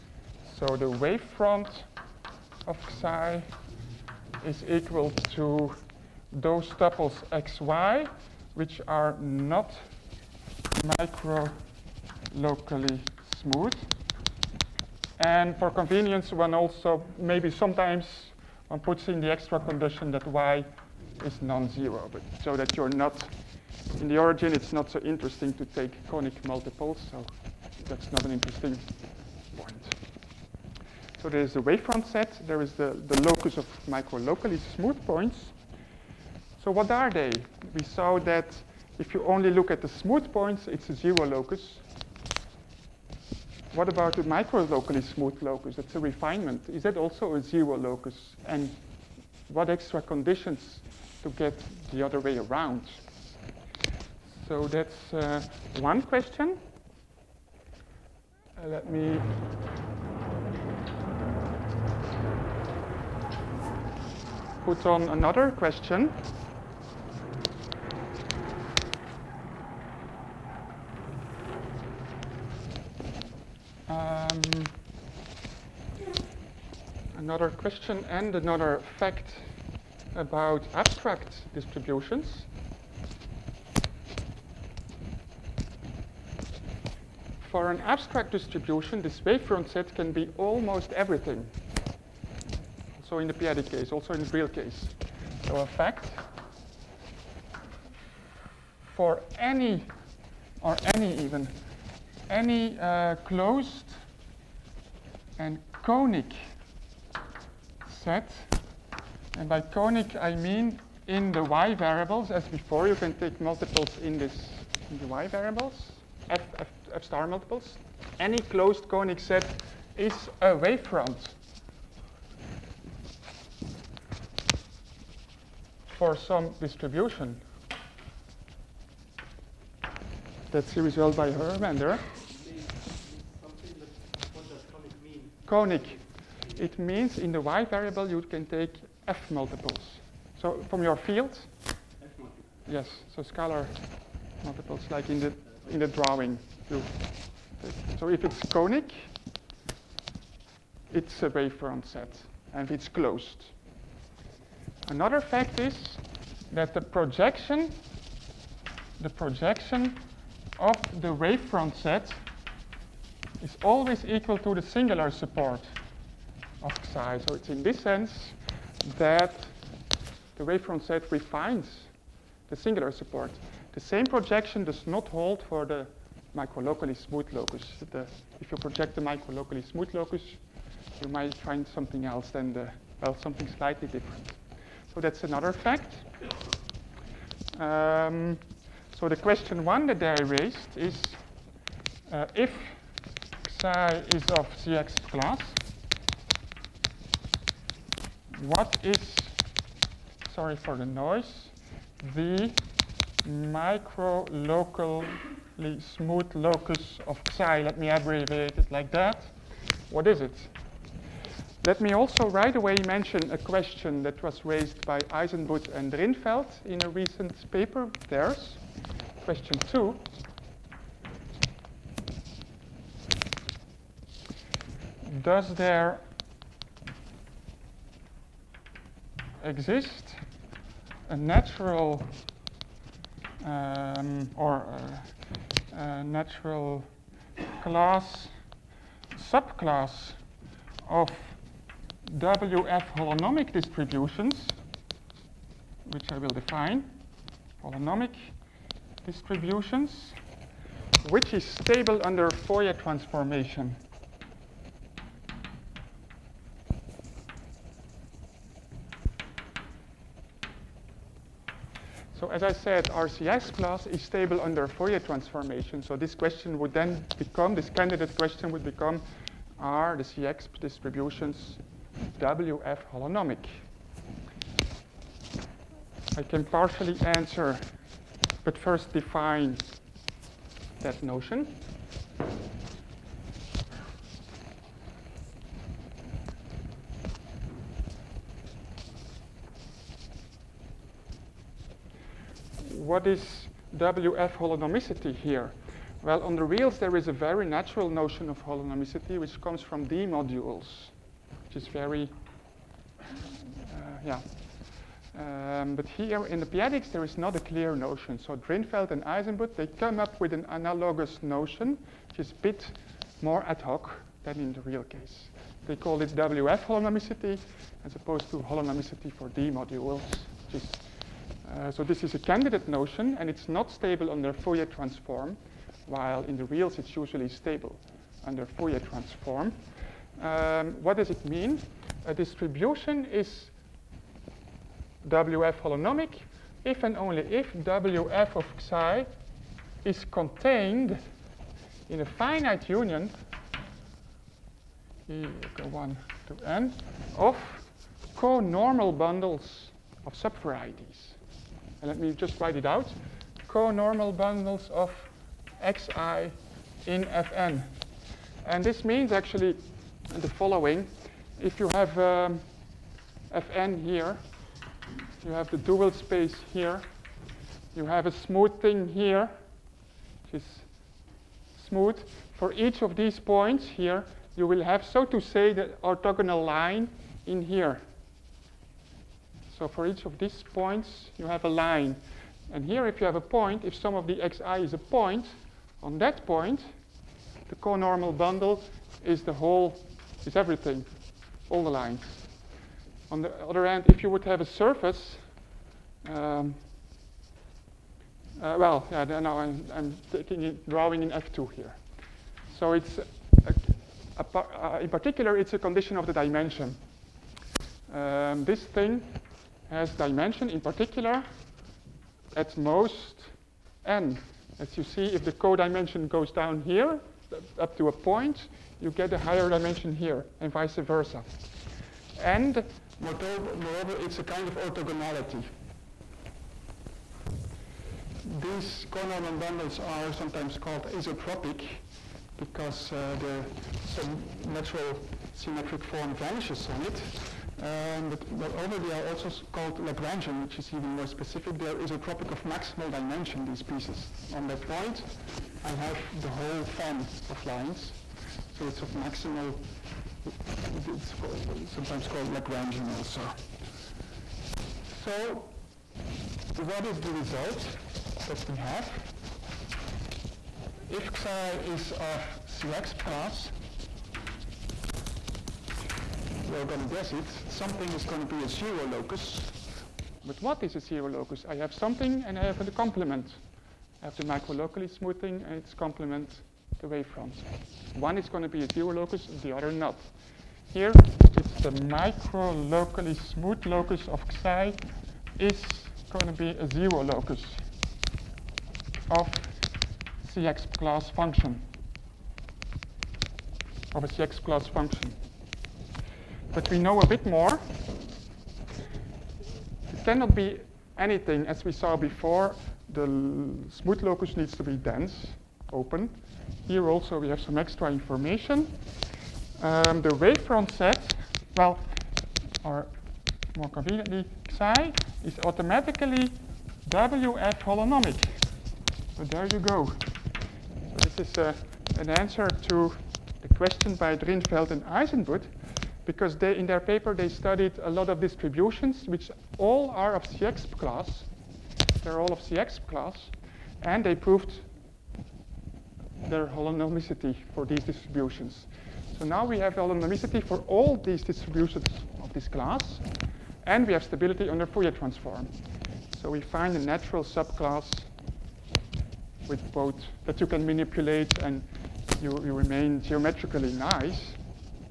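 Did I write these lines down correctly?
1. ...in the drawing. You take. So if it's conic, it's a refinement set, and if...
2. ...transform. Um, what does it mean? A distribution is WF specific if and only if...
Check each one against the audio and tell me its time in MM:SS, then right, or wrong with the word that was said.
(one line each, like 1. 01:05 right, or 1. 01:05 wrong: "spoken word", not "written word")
1. 02:25 wrong: "wavefront", not "refinement"
2. 05:28 wrong: "holonomic", not "specific".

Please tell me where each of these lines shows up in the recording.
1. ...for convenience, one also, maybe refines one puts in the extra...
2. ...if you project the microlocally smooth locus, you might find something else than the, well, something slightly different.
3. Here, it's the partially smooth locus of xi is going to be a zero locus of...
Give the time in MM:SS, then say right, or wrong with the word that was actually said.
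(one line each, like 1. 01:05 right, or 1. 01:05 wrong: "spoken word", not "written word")
1. 00:15 wrong: "sometimes", not "refines"
2. 02:58 right
3. 08:00 wrong: "microlocally", not "partially".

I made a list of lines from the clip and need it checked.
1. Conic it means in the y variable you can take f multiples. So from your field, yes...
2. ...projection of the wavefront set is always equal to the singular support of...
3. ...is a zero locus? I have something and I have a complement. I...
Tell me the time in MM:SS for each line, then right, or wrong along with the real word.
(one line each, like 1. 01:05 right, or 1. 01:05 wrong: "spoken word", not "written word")
1. 02:15 right
2. 02:39 right
3. 07:50 right.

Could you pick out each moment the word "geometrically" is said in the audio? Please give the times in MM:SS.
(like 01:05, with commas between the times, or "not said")
09:13.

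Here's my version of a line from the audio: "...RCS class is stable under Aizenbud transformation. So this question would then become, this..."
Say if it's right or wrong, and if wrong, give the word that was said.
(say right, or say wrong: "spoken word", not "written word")
wrong: "Fourier", not "Aizenbud".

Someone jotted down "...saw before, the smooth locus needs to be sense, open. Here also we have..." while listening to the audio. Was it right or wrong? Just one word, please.
wrong.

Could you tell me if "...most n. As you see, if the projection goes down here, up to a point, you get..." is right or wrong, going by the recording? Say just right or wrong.
wrong.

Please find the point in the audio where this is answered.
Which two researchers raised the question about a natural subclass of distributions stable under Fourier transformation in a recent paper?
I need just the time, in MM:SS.
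03:35.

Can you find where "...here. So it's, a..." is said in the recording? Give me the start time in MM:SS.
06:41.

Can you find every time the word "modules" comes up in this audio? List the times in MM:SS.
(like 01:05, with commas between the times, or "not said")
05:00, 05:19.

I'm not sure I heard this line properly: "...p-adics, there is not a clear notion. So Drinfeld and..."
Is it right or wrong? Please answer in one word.
right.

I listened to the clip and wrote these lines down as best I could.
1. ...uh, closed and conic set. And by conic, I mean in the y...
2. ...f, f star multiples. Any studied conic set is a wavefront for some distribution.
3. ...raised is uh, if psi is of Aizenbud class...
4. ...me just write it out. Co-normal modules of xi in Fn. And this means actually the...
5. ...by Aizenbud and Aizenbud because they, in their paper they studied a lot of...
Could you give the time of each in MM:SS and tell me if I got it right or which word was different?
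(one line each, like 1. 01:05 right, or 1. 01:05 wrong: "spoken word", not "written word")
1. 01:42 right
2. 01:56 wrong: "closed", not "studied"
3. 03:10 wrong: "Cexp", not "Aizenbud"
4. 05:51 wrong: "bundles", not "modules"
5. 08:43 wrong: "Drinfeld", not "Aizenbud".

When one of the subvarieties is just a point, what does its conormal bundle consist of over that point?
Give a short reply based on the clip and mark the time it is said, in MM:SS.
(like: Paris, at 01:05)
all the lines, at 06:31.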